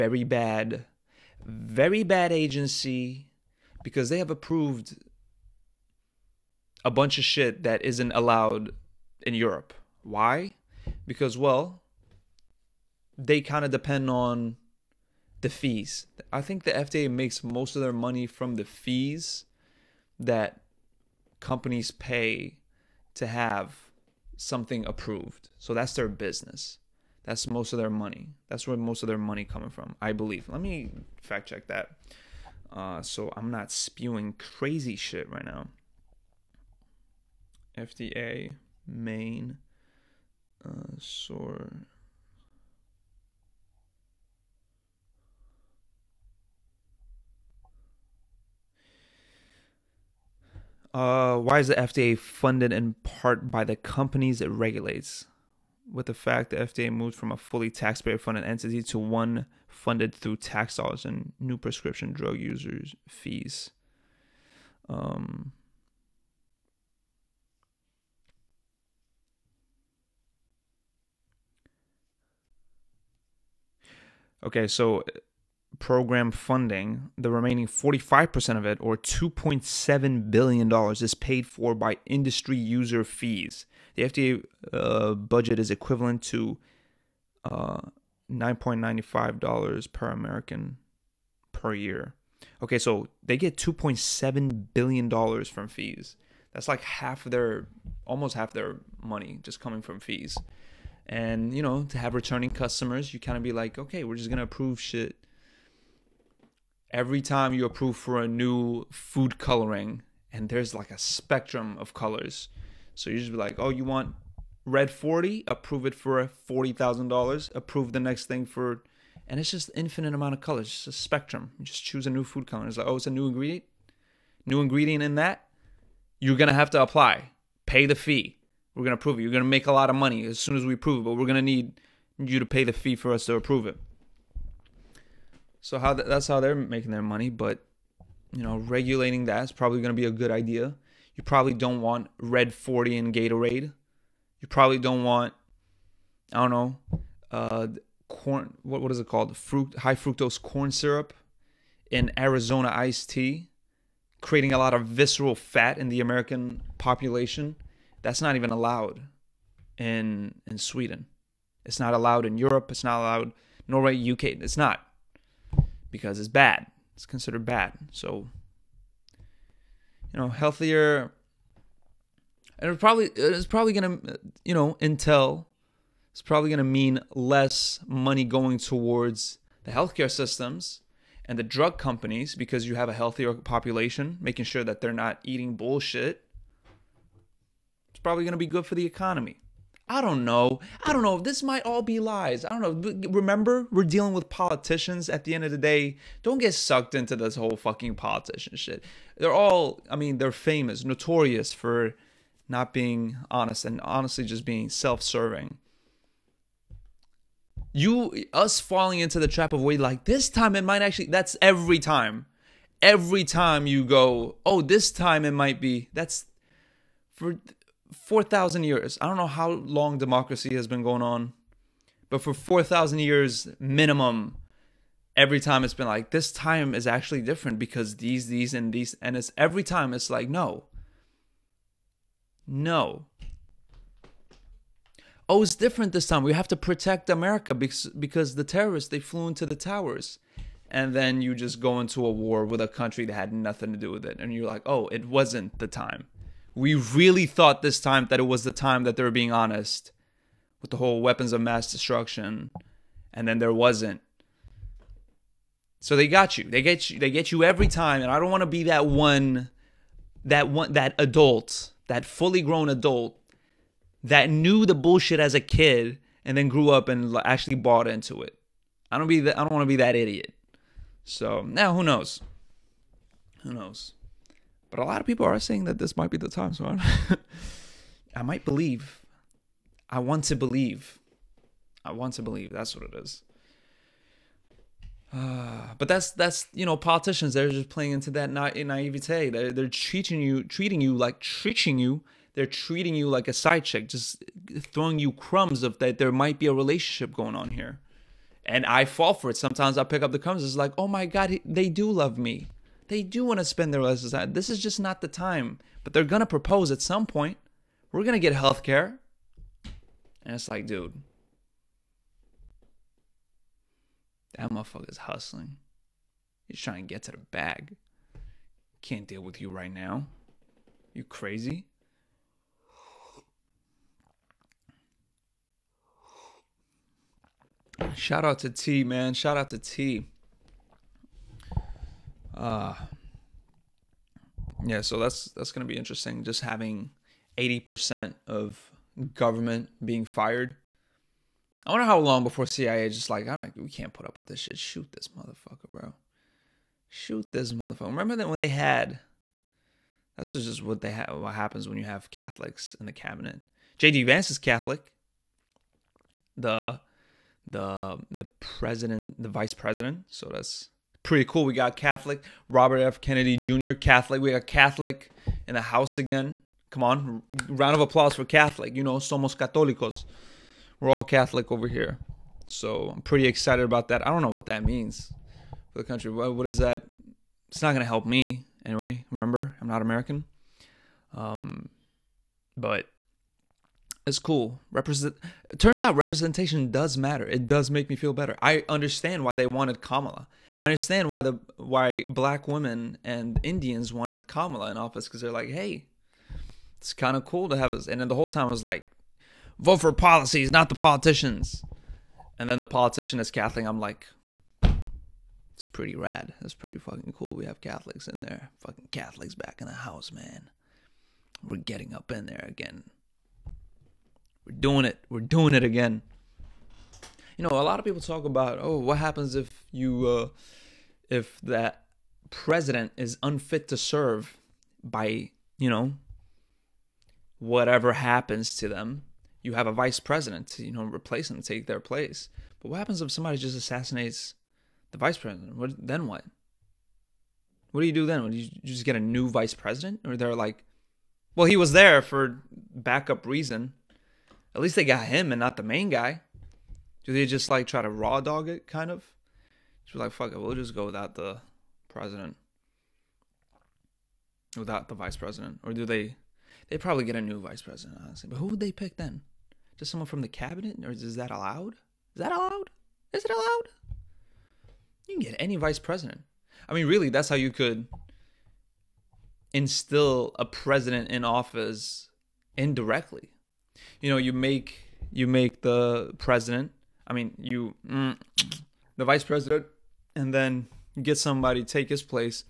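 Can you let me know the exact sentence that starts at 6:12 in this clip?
So I'm pretty excited about that.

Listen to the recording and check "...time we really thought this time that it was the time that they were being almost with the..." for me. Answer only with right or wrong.
wrong.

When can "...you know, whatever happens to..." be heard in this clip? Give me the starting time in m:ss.
7:05.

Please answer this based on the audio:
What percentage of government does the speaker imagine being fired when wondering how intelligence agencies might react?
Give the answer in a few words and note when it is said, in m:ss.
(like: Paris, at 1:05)
80%, at 5:37.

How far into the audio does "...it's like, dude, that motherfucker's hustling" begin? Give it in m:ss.
5:10.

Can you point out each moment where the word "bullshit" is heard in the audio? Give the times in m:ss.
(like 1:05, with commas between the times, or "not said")
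3:05, 4:24.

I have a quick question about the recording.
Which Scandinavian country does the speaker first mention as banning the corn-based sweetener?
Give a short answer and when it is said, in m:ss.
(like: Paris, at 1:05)
Sweden, at 2:40.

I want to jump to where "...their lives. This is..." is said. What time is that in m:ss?
5:03.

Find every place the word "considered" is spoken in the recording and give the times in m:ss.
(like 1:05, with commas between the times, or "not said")
2:47.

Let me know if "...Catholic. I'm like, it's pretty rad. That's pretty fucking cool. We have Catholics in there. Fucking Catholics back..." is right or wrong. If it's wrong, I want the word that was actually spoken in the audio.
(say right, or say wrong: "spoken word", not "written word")
right.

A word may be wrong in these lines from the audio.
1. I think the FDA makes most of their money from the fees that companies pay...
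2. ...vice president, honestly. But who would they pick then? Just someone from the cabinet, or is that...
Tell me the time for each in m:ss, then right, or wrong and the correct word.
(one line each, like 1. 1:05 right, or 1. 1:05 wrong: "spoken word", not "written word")
1. 0:16 right
2. 7:37 right.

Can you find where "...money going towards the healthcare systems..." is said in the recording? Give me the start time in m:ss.
2:57.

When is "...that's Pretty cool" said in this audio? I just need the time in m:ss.
6:00.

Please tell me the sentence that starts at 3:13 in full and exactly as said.
Remember, we're dealing with politicians at the end of the day.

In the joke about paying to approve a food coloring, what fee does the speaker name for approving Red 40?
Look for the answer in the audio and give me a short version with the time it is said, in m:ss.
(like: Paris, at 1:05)
$40,000, at 1:56.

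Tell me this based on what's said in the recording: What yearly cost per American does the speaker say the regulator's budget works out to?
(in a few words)
$9.95.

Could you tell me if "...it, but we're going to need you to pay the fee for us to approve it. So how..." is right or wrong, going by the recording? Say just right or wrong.
right.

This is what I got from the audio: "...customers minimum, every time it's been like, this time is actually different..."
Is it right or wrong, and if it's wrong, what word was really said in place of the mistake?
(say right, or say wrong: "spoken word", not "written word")
wrong: "years", not "customers".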